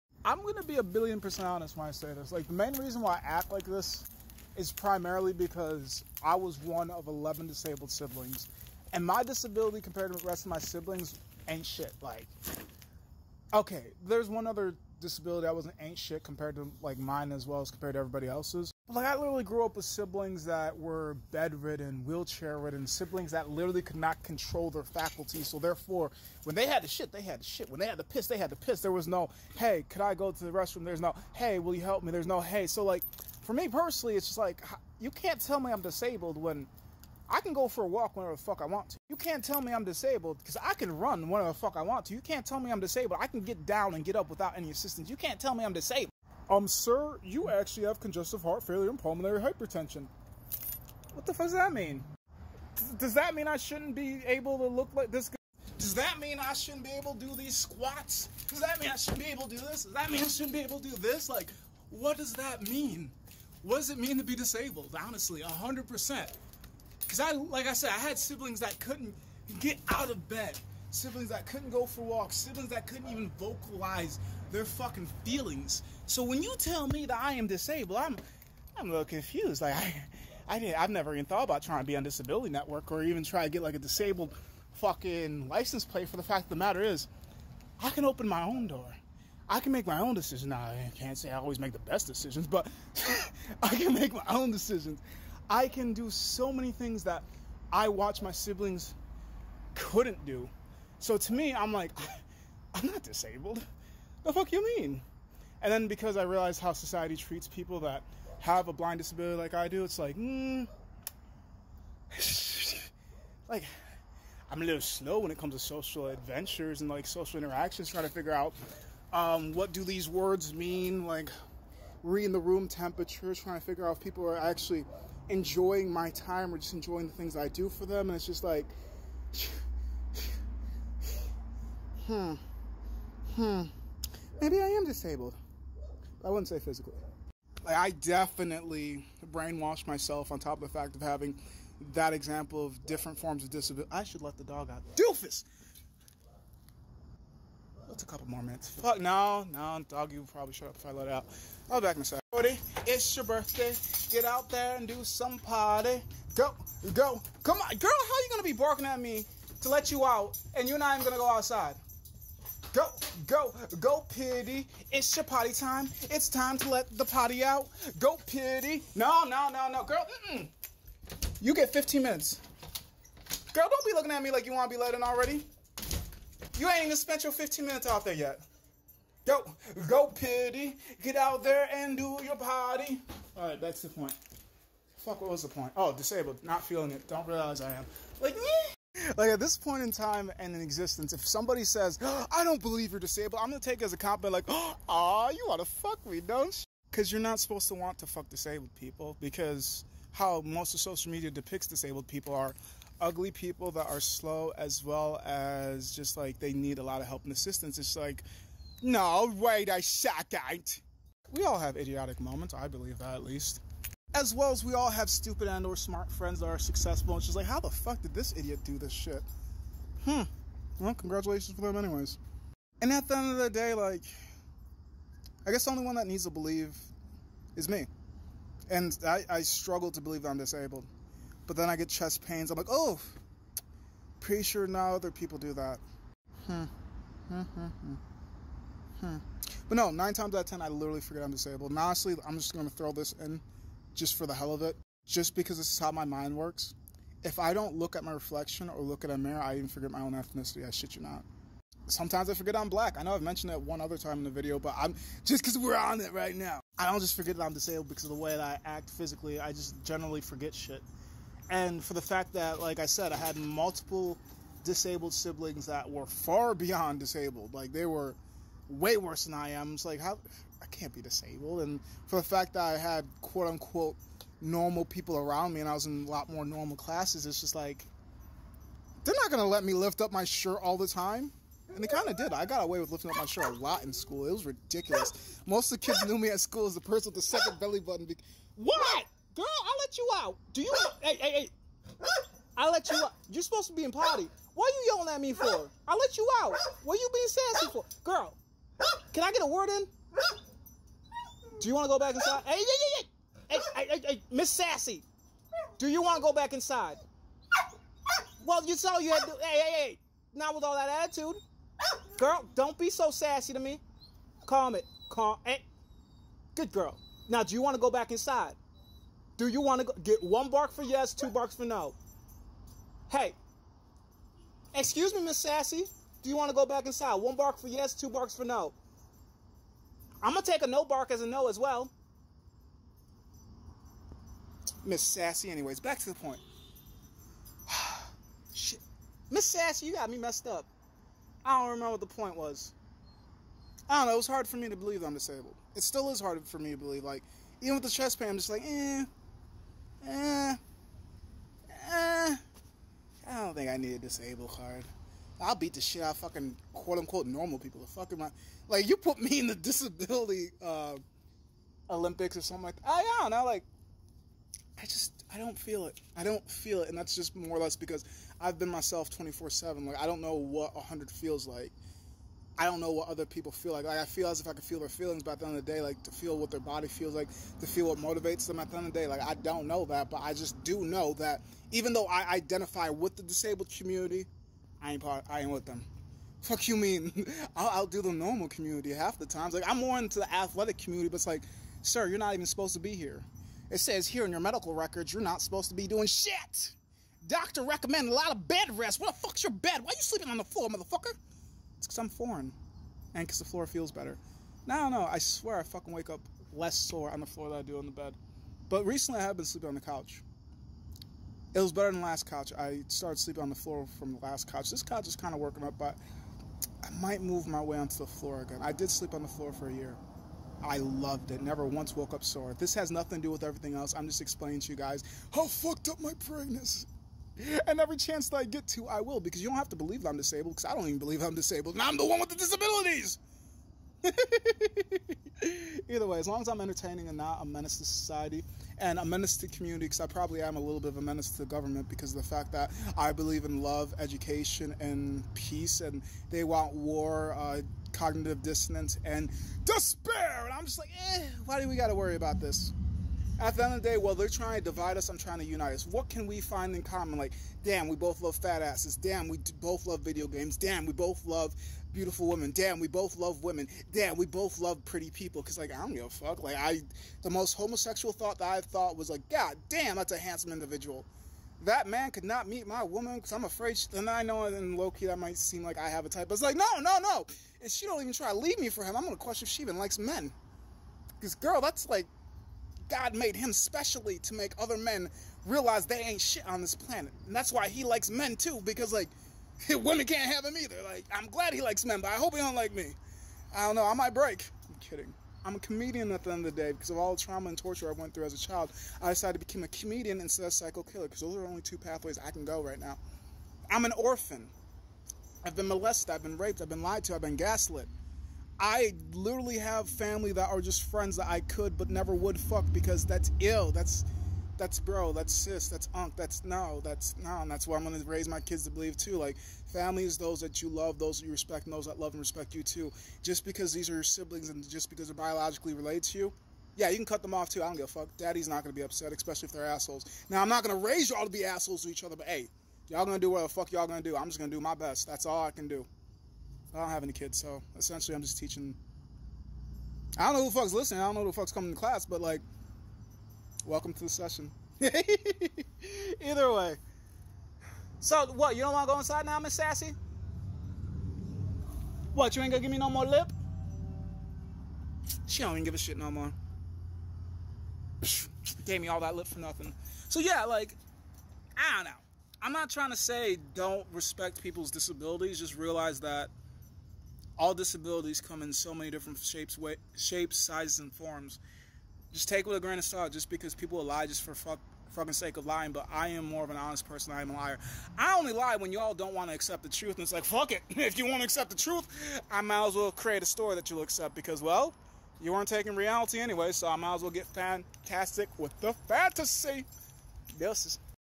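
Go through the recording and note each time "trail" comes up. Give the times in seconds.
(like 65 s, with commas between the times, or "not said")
not said.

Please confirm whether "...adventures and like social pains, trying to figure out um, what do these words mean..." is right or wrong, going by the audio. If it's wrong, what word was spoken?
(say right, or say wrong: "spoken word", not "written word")
wrong: "interactions", not "pains".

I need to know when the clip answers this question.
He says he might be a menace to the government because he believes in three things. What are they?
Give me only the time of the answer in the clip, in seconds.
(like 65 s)
443 s.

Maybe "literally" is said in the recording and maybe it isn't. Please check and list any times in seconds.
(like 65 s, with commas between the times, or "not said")
19 s, 23 s, 240 s, 509 s.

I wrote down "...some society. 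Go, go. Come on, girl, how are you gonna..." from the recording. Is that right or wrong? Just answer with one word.
wrong.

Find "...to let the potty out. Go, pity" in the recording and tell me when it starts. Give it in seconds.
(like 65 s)
166 s.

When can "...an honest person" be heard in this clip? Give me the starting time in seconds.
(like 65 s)
576 s.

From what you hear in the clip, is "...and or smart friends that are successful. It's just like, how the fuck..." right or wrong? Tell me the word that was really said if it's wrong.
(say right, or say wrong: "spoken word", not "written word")
right.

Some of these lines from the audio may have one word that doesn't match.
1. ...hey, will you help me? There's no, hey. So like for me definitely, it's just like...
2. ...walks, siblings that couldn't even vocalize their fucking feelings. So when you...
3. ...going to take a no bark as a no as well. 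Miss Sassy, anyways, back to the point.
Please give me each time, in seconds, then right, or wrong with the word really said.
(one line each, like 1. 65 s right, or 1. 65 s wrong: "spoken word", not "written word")
1. 31 s wrong: "personally", not "definitely"
2. 72 s right
3. 330 s right.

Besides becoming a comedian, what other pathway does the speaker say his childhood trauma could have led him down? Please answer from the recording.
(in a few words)
psycho killer.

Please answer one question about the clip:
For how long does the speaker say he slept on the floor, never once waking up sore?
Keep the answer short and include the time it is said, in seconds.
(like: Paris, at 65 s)
a year, at 419 s.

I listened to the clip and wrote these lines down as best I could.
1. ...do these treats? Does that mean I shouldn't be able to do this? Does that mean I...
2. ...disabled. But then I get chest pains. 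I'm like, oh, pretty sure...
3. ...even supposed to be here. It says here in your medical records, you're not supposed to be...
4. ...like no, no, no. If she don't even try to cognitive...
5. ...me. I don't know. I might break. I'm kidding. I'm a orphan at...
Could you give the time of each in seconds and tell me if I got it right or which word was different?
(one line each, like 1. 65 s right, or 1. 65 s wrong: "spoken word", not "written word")
1. 57 s wrong: "squats", not "treats"
2. 230 s right
3. 392 s right
4. 476 s wrong: "leave", not "cognitive"
5. 492 s wrong: "comedian", not "orphan".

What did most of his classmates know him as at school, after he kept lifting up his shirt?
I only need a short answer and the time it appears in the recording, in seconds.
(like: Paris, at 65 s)
the person with the second belly button, at 287 s.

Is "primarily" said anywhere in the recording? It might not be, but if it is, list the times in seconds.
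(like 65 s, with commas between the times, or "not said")
4 s.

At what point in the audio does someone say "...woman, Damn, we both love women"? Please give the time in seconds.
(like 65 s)
462 s.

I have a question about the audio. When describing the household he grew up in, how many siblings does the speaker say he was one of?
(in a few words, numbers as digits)
11.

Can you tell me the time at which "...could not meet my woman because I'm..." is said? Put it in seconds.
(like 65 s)
472 s.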